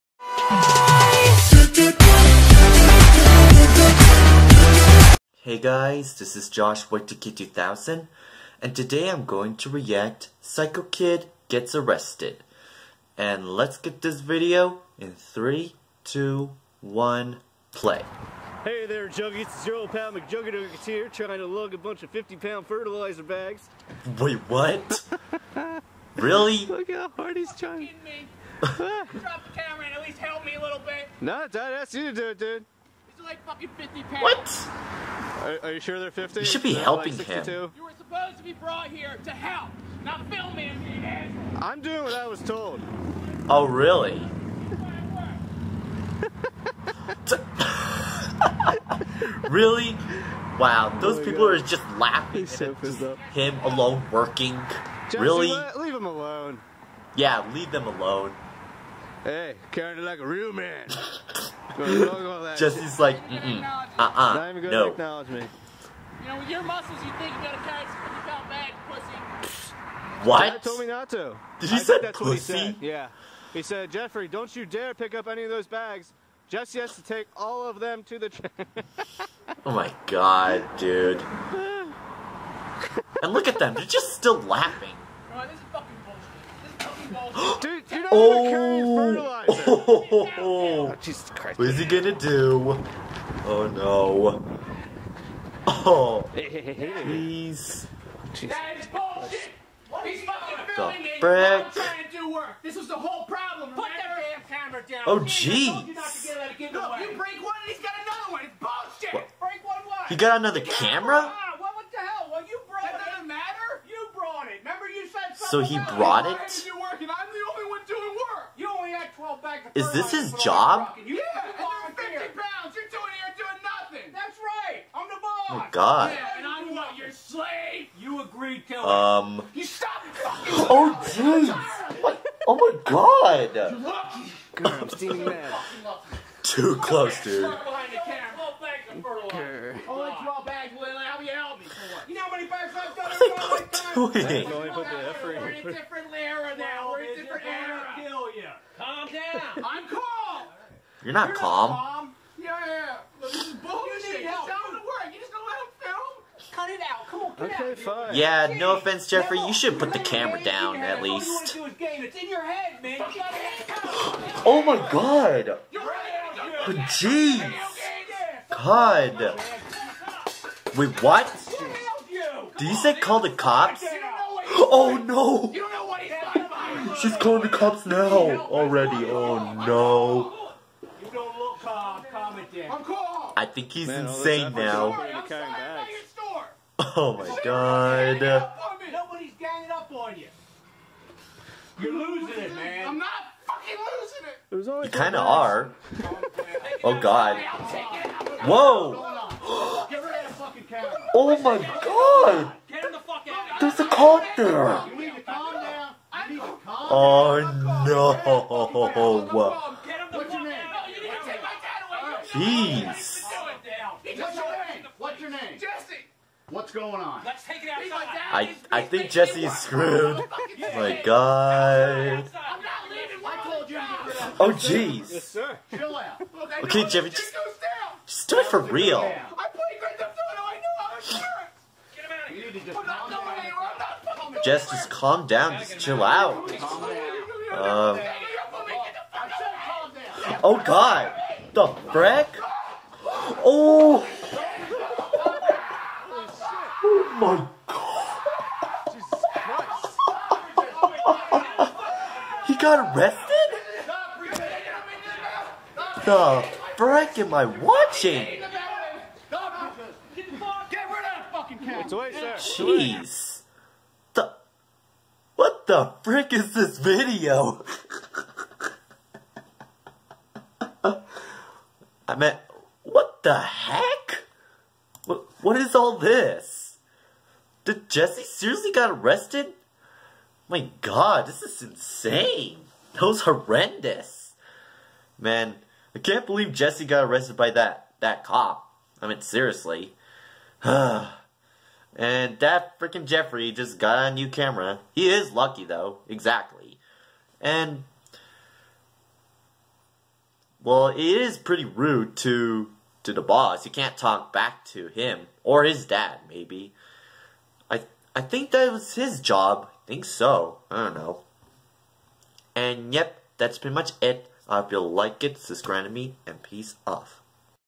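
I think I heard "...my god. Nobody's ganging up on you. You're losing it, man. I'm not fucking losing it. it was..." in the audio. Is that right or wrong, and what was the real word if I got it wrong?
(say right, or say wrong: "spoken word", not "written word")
right.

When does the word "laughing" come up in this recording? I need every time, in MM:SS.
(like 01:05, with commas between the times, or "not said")
00:51, 01:24.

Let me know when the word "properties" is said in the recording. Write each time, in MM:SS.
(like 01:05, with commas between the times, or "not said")
not said.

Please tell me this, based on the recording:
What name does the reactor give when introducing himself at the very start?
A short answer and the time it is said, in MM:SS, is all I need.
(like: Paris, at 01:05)
JOSHY2K 2000, at 00:06.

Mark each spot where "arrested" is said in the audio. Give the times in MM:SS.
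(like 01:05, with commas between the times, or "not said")
00:11, 04:12, 04:38, 04:47.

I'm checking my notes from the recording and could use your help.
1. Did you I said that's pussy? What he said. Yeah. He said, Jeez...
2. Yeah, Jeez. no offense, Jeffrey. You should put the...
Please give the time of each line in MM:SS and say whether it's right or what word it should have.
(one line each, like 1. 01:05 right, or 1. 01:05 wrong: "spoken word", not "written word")
1. 01:11 wrong: "Jeffrey", not "Jeez"
2. 02:38 right.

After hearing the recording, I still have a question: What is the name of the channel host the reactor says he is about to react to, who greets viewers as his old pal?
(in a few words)
McJuggerNuggets.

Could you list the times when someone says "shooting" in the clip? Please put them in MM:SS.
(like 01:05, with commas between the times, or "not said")
not said.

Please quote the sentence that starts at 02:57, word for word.
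She's calling the cops now already.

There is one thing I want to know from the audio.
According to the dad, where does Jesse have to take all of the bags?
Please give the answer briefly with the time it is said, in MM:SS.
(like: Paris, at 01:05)
the train, at 01:18.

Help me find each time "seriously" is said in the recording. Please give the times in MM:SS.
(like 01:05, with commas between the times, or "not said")
04:38, 04:49.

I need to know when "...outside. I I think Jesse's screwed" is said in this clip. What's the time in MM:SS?
03:37.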